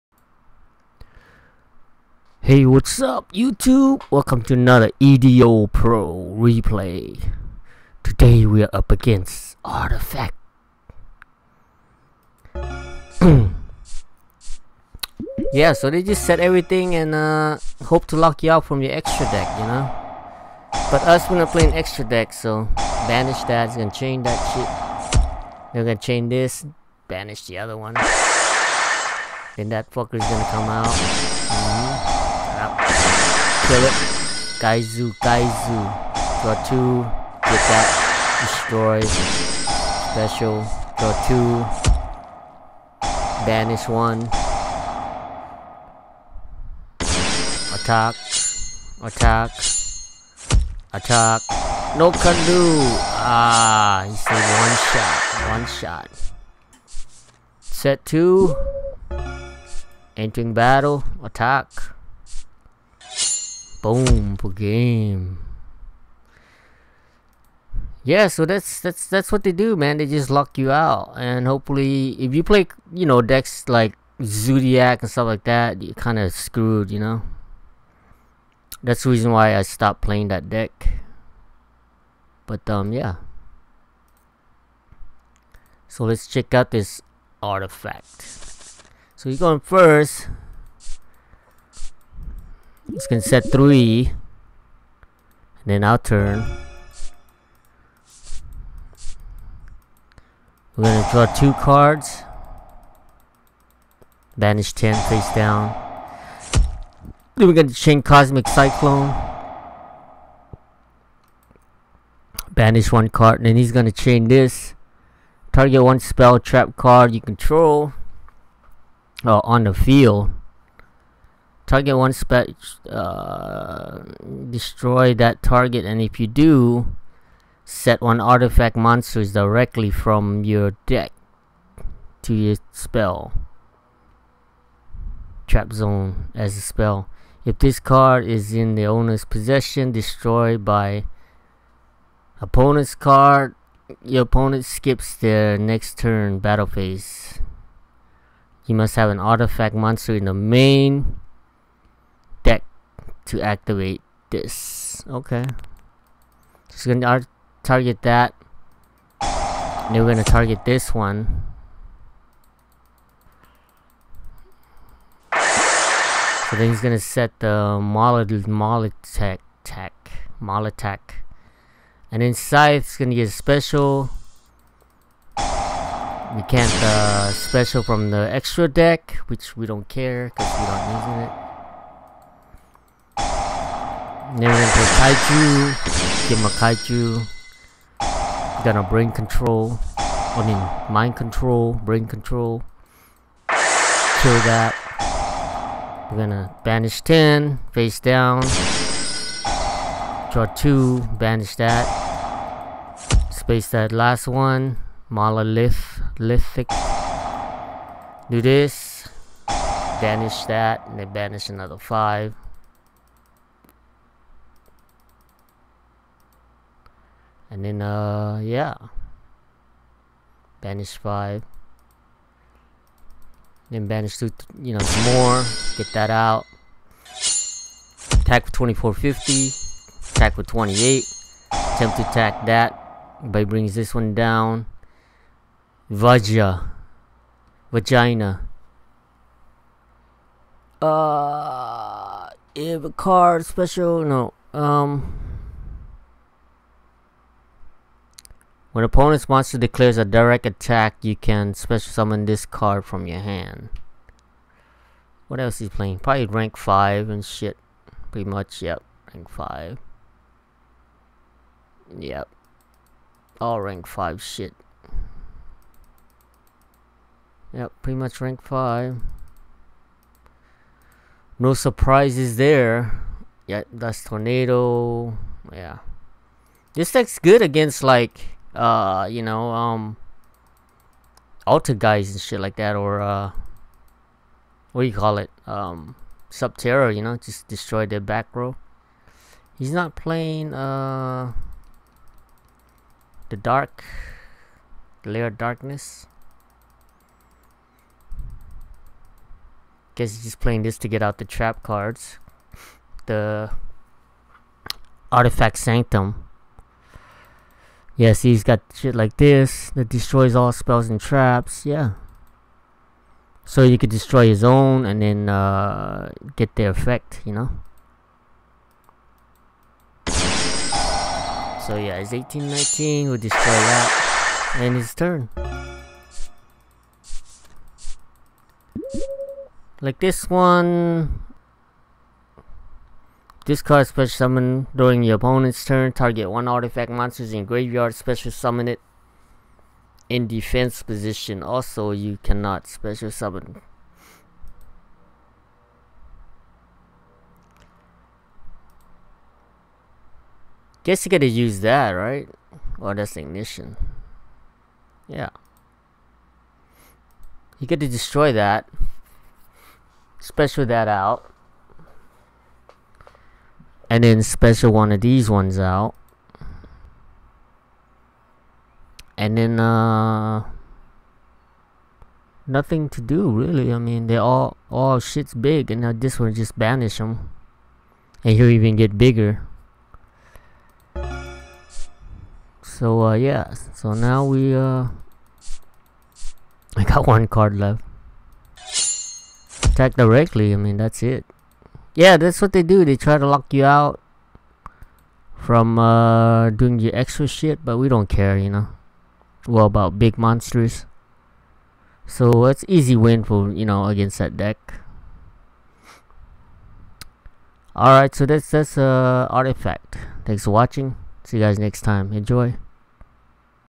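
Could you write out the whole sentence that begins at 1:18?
That's the reason why I stopped playing that deck.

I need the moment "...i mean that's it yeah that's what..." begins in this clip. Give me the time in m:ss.
6:30.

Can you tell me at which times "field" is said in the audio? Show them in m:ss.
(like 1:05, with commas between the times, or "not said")
1:59.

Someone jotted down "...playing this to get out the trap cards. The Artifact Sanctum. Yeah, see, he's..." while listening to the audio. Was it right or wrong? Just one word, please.
right.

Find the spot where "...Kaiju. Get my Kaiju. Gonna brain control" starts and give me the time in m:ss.
3:05.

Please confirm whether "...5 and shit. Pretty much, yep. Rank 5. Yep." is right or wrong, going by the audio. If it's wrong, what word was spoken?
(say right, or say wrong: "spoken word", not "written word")
right.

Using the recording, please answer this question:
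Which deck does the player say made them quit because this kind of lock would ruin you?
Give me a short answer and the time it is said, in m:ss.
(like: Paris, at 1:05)
Zodiac, at 1:14.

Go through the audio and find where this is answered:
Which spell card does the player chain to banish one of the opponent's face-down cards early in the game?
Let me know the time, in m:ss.
1:48.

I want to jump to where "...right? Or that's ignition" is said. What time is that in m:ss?
5:51.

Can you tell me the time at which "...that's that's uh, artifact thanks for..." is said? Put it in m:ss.
6:48.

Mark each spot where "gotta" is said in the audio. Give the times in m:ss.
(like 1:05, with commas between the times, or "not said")
5:51, 5:57.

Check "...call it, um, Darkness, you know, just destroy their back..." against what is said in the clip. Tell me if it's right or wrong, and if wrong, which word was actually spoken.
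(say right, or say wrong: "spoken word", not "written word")
wrong: "Subterror", not "Darkness".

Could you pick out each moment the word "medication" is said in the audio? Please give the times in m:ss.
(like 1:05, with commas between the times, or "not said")
not said.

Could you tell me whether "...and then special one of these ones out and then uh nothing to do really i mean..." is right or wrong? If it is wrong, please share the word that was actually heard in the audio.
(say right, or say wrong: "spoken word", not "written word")
right.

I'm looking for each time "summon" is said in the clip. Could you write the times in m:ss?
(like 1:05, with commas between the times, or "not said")
4:11, 5:34, 5:38, 5:43.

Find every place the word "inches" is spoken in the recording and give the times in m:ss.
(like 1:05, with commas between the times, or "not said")
not said.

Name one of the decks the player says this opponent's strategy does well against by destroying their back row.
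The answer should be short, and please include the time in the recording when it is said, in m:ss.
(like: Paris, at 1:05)
Altergeists, at 4:41.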